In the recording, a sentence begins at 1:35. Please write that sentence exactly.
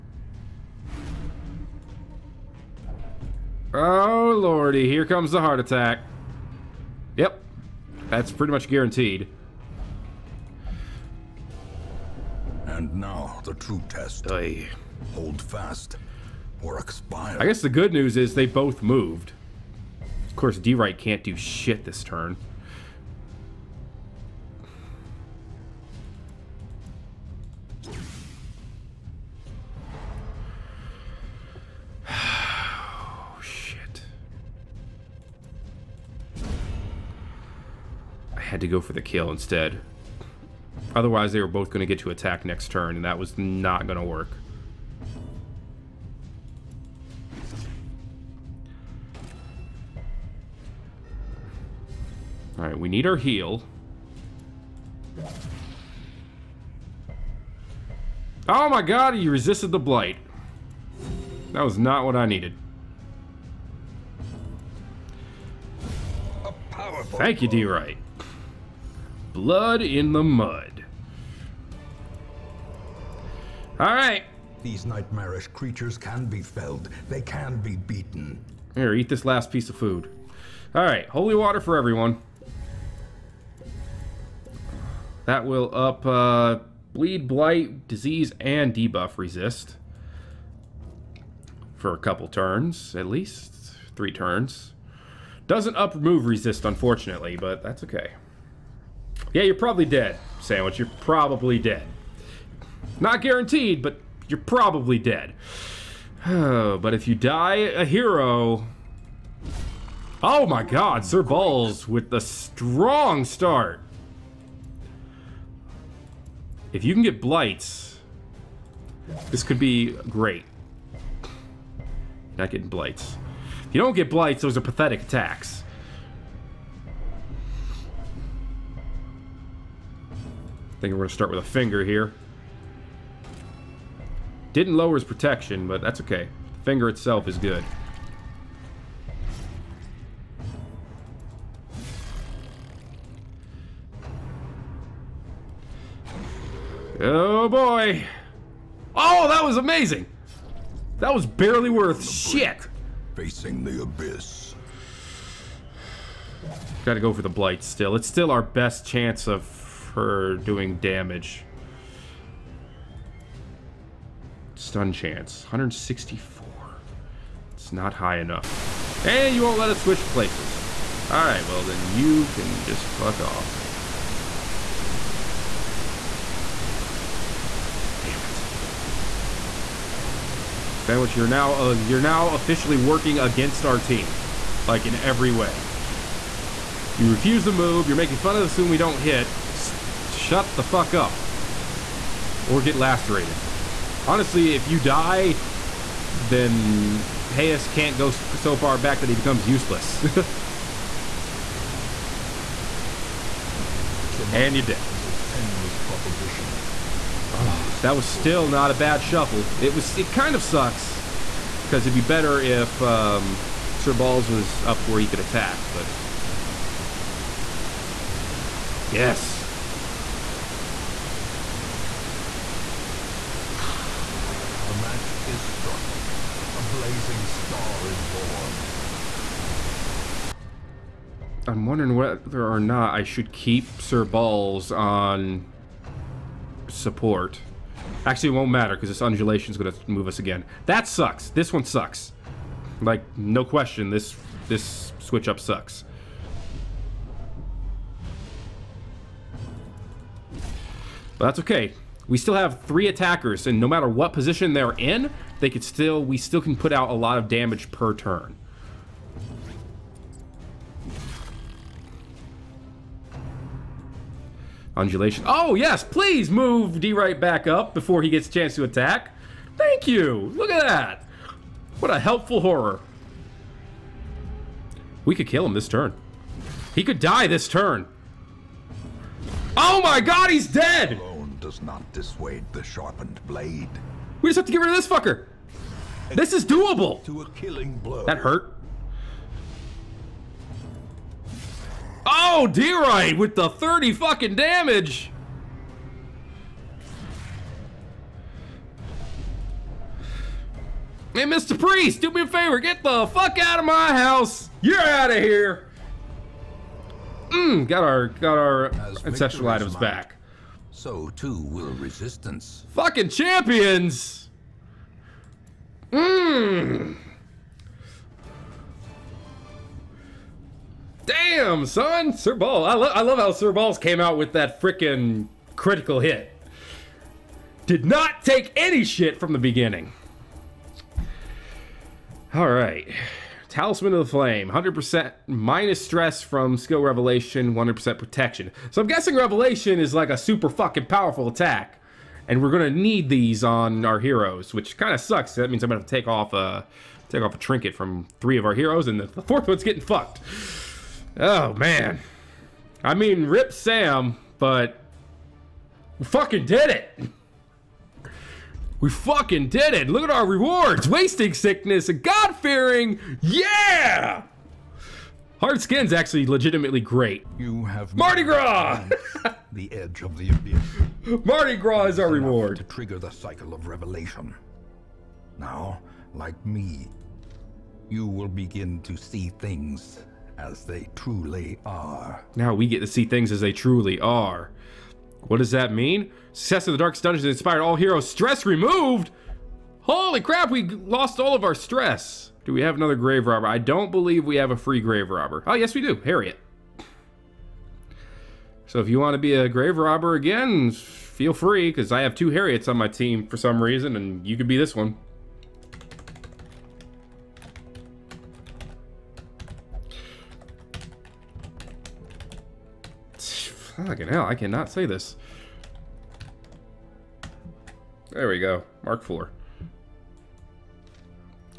Doesn't up move resist, unfortunately, but that's okay.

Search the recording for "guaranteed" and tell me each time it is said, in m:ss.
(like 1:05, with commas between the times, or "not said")
0:08, 1:43.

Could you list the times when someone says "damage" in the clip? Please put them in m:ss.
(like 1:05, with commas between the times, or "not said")
2:40, 4:17, 4:54.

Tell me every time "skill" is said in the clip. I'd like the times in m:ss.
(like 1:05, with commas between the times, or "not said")
5:36.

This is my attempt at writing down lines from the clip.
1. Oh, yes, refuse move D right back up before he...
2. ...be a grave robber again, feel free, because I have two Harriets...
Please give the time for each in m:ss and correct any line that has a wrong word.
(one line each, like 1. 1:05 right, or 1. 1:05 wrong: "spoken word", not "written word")
1. 4:25 wrong: "please", not "refuse"
2. 6:39 right.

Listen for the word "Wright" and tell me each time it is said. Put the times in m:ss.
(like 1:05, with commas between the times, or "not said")
0:20, 1:07.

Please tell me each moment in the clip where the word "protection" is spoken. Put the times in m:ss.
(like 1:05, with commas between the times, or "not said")
2:15, 5:37.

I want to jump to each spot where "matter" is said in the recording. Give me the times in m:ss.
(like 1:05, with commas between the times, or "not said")
3:58, 4:13.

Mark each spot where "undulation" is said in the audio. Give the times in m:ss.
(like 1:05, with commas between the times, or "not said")
3:59, 4:24.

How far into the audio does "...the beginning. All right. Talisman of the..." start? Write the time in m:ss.
5:29.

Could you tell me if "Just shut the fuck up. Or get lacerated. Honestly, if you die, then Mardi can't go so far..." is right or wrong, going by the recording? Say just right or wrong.
wrong.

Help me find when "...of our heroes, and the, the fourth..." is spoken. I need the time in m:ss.
5:48.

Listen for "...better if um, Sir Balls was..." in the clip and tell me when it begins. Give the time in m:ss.
3:31.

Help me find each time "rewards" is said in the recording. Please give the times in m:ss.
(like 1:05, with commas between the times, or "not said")
6:00, 6:12.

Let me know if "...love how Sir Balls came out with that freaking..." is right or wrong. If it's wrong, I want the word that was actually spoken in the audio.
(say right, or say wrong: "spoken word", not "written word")
right.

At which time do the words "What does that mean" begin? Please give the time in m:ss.
6:25.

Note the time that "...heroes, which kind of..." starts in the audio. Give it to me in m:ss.
5:43.